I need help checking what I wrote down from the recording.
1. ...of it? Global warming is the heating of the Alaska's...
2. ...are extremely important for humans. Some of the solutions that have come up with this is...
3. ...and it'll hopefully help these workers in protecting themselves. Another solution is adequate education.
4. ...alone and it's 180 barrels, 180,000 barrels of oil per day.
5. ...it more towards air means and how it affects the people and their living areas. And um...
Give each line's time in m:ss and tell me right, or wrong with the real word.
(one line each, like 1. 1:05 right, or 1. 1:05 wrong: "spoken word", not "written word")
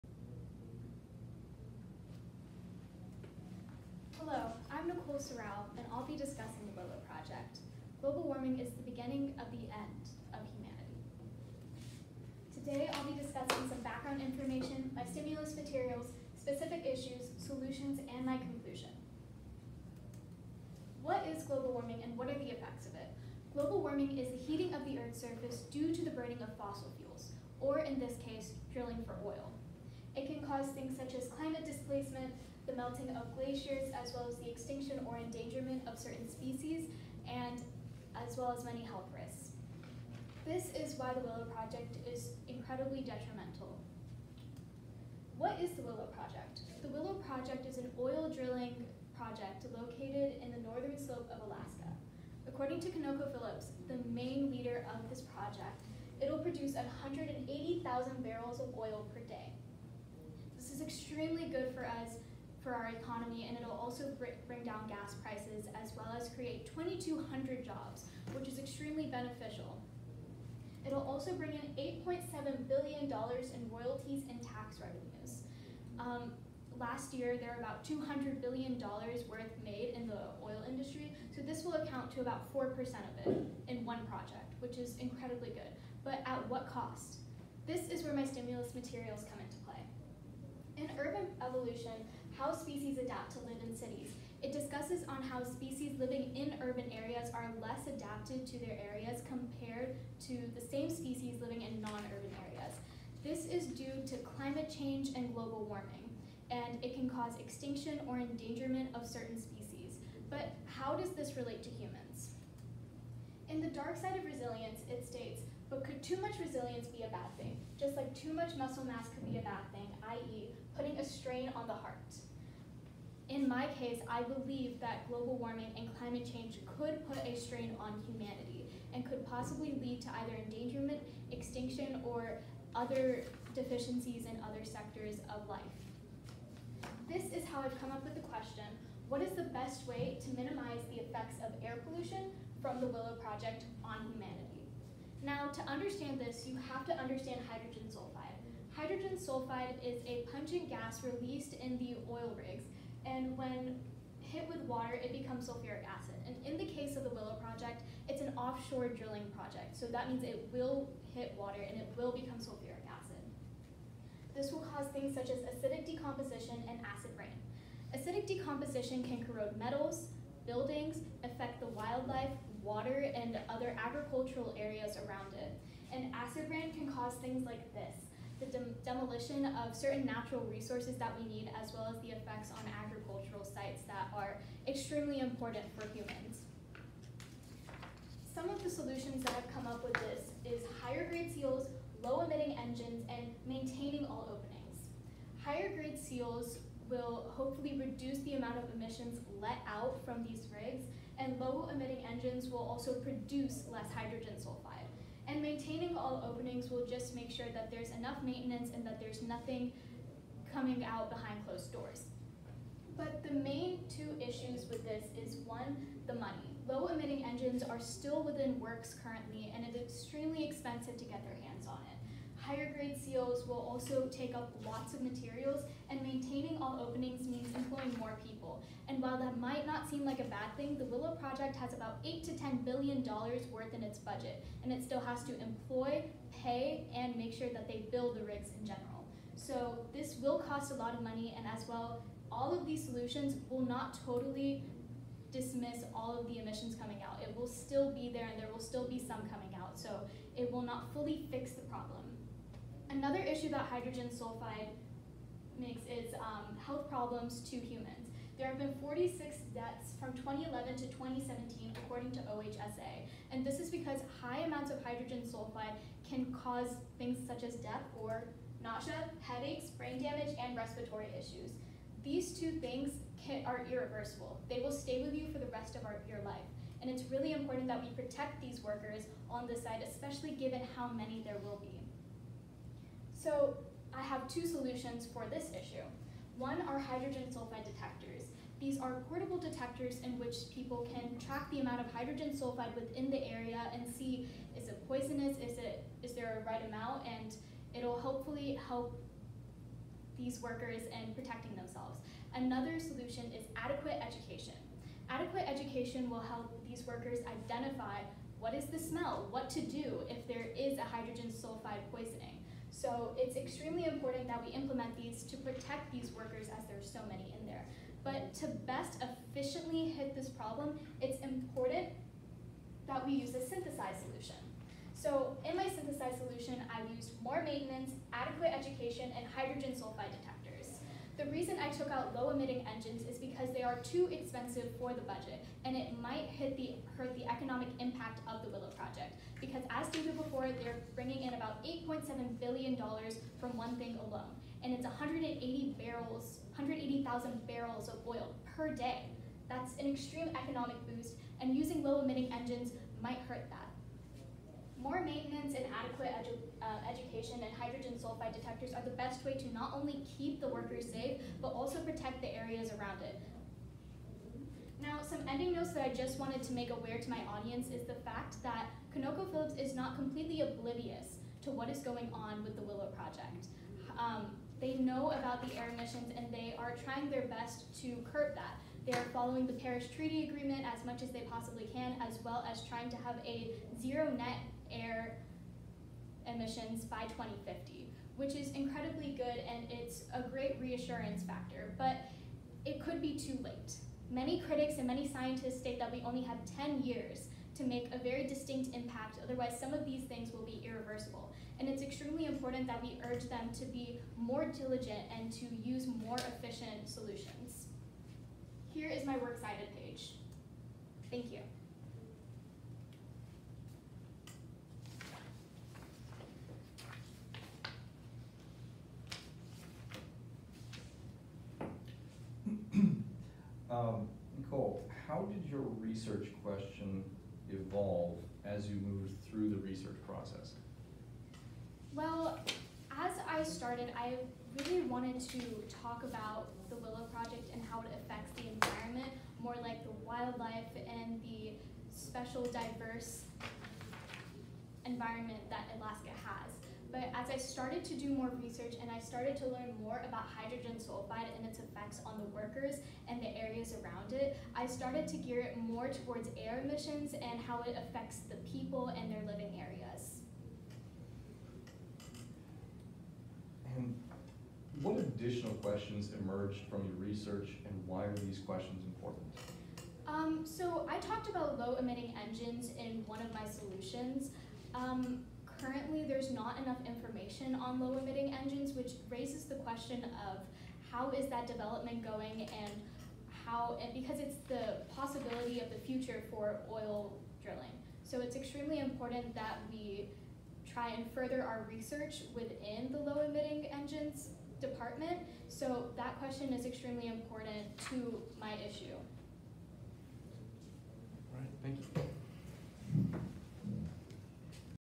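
1. 0:22 wrong: "Earth", not "Alaska"
2. 3:04 right
3. 4:57 right
4. 5:44 right
5. 7:35 wrong: "emissions", not "means".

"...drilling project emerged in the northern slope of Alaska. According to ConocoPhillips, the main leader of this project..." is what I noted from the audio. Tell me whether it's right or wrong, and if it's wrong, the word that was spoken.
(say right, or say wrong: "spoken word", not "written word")
wrong: "located", not "emerged".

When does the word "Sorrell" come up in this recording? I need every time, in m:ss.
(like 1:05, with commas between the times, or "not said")
0:05.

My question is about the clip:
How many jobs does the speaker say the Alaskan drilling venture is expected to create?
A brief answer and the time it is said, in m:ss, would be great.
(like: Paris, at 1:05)
2,200, at 1:06.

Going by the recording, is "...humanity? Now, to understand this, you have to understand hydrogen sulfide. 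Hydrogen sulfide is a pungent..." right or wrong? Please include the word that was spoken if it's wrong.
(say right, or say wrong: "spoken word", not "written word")
right.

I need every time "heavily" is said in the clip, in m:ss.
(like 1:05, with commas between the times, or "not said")
not said.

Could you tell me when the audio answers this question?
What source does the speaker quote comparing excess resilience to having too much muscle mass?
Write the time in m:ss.
1:53.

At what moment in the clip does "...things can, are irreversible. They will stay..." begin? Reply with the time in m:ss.
4:32.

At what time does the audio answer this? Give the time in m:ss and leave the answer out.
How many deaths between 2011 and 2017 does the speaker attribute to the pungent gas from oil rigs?
4:18.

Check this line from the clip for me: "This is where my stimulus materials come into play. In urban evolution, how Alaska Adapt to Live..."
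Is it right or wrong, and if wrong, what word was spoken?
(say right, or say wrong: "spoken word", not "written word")
wrong: "Species", not "Alaska".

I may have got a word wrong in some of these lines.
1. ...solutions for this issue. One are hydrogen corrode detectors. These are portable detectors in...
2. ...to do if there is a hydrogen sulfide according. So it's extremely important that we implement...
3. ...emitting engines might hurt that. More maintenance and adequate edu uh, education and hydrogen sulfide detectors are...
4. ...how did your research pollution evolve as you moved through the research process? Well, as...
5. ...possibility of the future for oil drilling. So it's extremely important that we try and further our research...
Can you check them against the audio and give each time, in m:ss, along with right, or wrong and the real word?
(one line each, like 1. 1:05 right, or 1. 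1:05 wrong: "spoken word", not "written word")
1. 4:44 wrong: "sulfide", not "corrode"
2. 5:09 wrong: "poisoning", not "according"
3. 5:52 right
4. 7:05 wrong: "question", not "pollution"
5. 8:04 right.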